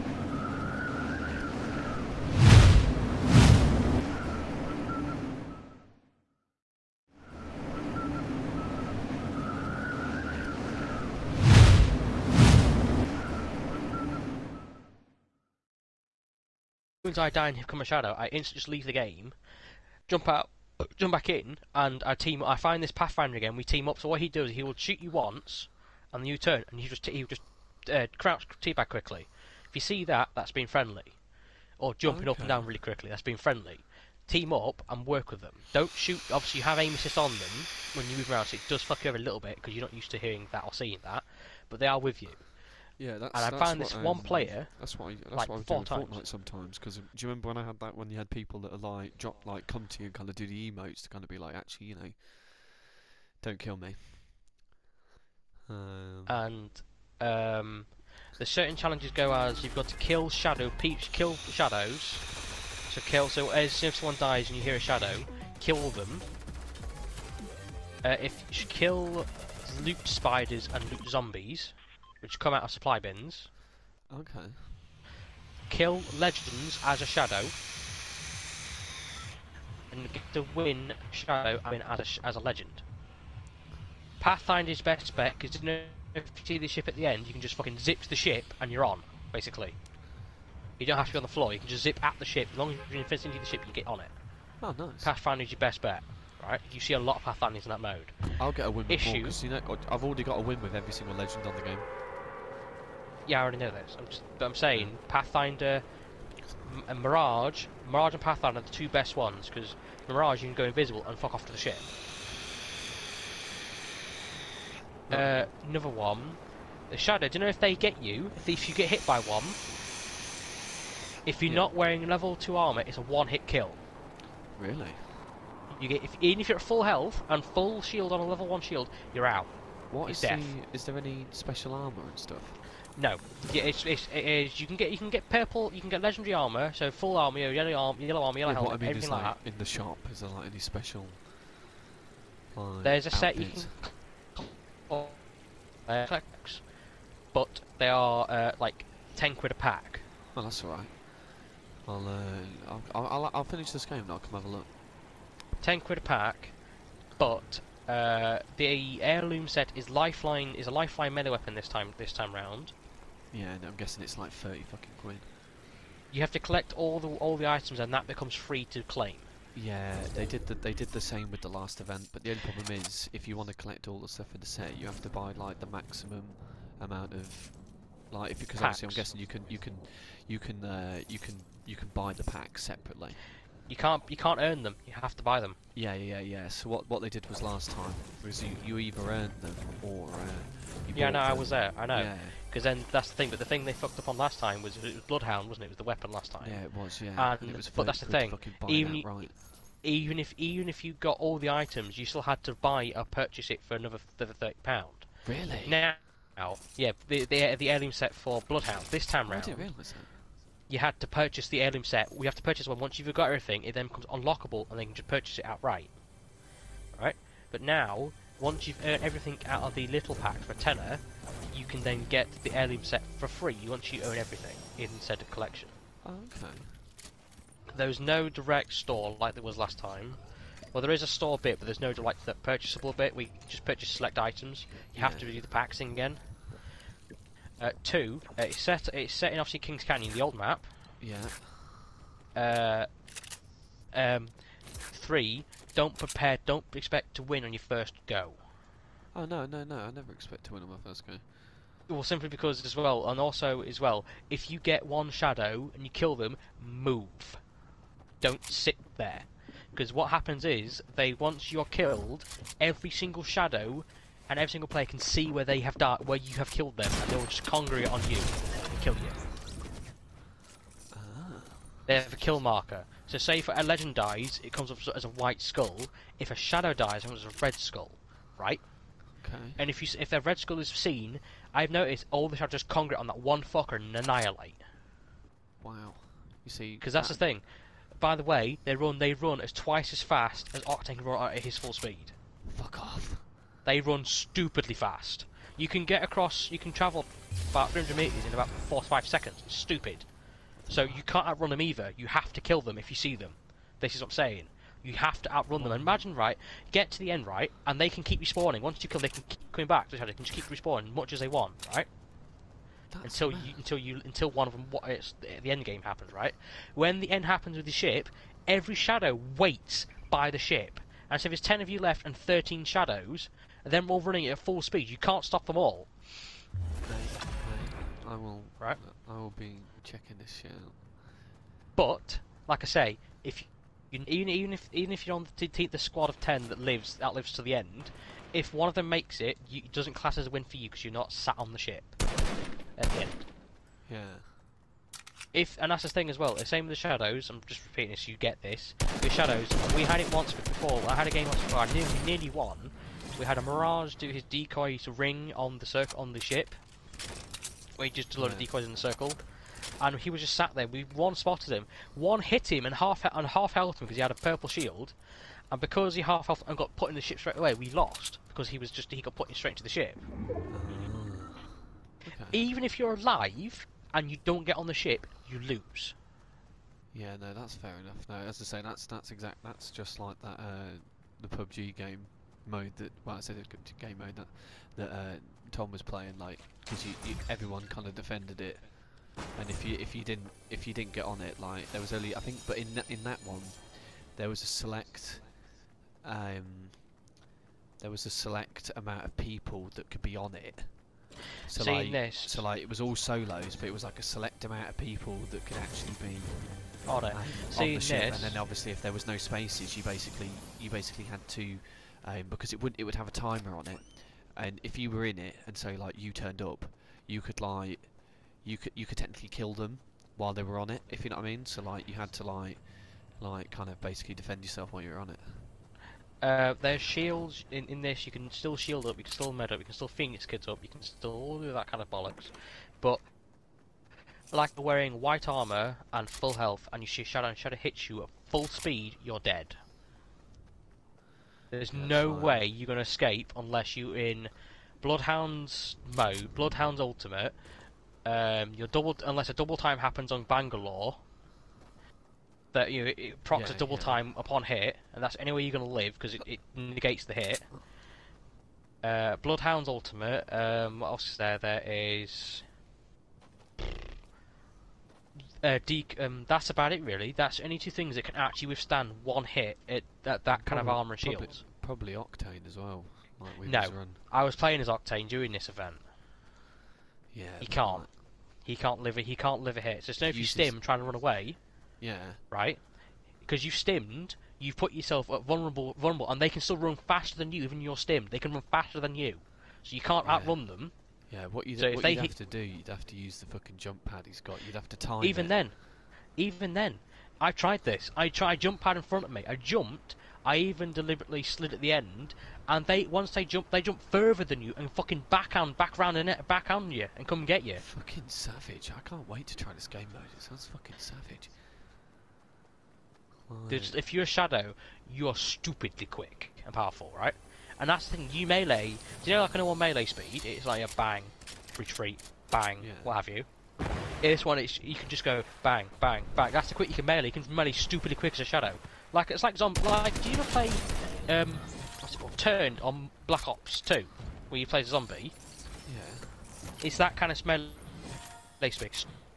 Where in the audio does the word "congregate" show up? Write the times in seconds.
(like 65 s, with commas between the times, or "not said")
267 s, 282 s.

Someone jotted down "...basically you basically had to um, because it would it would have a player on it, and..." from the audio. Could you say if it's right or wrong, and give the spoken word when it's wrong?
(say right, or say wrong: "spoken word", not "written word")
wrong: "timer", not "player".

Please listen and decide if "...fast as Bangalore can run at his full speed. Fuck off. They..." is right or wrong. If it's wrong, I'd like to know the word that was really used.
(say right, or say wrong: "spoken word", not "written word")
wrong: "Octane", not "Bangalore".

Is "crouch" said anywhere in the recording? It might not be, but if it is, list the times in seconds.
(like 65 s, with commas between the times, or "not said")
28 s.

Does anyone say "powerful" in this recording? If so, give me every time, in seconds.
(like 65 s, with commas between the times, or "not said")
516 s.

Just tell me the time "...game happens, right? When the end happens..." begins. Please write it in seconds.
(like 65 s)
315 s.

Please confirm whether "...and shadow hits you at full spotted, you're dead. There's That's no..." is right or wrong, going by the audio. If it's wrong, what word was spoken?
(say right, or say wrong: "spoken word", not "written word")
wrong: "speed", not "spotted".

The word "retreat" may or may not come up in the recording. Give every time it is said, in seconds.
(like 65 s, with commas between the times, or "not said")
521 s.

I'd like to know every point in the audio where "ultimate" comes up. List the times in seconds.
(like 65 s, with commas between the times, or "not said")
446 s, 459 s.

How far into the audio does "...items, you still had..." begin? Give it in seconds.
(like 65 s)
201 s.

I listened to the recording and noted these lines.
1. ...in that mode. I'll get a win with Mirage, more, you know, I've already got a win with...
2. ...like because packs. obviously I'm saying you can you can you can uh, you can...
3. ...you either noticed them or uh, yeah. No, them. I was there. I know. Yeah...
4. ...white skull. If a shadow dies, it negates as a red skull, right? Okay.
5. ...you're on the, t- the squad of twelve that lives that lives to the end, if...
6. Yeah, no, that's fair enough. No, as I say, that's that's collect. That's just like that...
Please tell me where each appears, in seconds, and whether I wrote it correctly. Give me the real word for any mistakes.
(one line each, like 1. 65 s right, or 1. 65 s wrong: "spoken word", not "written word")
1. 97 s wrong: "Issue", not "Mirage"
2. 178 s wrong: "guessing", not "saying"
3. 188 s wrong: "earned", not "noticed"
4. 275 s wrong: "comes", not "negates"
5. 335 s wrong: "ten", not "twelve"
6. 376 s wrong: "exact", not "collect".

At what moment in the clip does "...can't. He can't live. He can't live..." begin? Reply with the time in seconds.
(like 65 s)
477 s.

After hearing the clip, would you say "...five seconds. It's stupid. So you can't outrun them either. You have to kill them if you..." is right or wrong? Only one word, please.
right.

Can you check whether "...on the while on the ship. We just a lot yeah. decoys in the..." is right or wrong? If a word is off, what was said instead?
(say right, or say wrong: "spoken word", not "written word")
wrong: "circle", not "while".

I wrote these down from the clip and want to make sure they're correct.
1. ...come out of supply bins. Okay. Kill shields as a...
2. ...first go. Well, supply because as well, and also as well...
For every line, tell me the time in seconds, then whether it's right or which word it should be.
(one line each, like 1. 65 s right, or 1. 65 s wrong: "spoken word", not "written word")
1. 72 s wrong: "legends", not "shields"
2. 250 s wrong: "simply", not "supply".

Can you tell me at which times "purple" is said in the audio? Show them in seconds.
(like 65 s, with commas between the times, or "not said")
135 s, 364 s.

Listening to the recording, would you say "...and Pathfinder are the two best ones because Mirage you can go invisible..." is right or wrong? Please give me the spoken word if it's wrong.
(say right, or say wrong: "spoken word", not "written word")
right.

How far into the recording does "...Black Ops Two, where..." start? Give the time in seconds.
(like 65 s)
533 s.